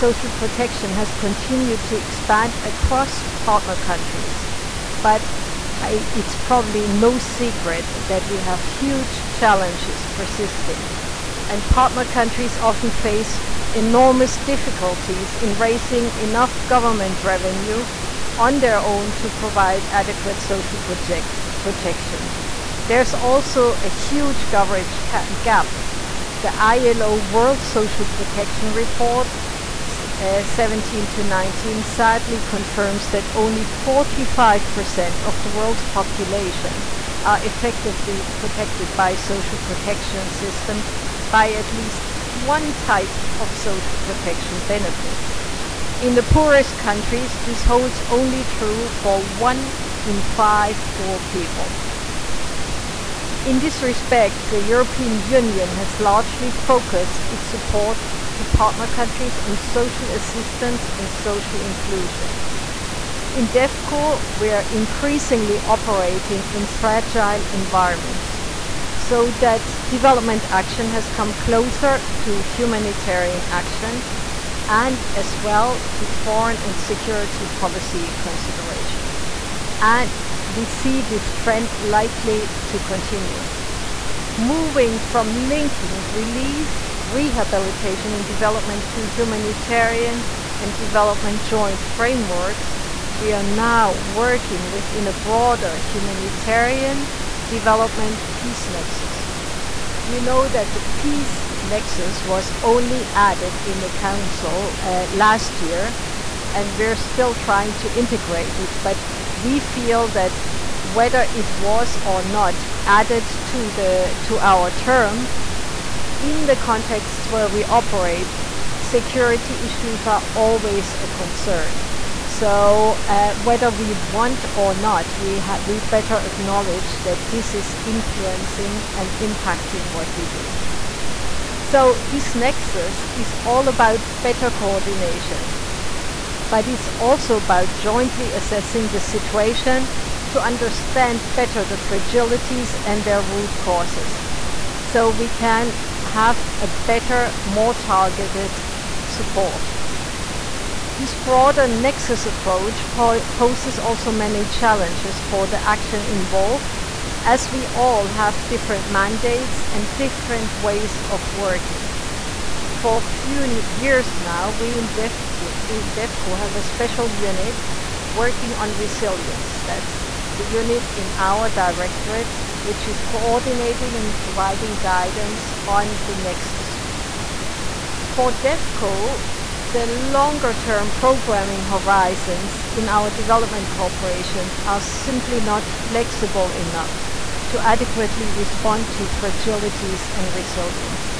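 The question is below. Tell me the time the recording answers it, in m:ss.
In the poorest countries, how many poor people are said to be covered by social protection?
0:49.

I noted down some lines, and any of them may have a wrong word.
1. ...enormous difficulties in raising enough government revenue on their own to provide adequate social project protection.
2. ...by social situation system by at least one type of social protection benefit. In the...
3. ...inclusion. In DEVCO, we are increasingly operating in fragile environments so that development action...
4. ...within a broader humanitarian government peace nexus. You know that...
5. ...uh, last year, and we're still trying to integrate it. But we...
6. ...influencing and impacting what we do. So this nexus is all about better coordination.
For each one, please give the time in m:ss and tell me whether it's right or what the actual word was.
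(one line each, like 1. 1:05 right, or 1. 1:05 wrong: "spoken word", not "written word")
1. 0:13 right
2. 0:38 wrong: "protection", not "situation"
3. 1:01 right
4. 1:34 wrong: "development", not "government"
5. 1:44 right
6. 2:07 right.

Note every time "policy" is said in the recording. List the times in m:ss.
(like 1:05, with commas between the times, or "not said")
1:17.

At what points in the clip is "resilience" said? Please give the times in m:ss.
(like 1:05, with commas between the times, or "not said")
2:48, 3:10.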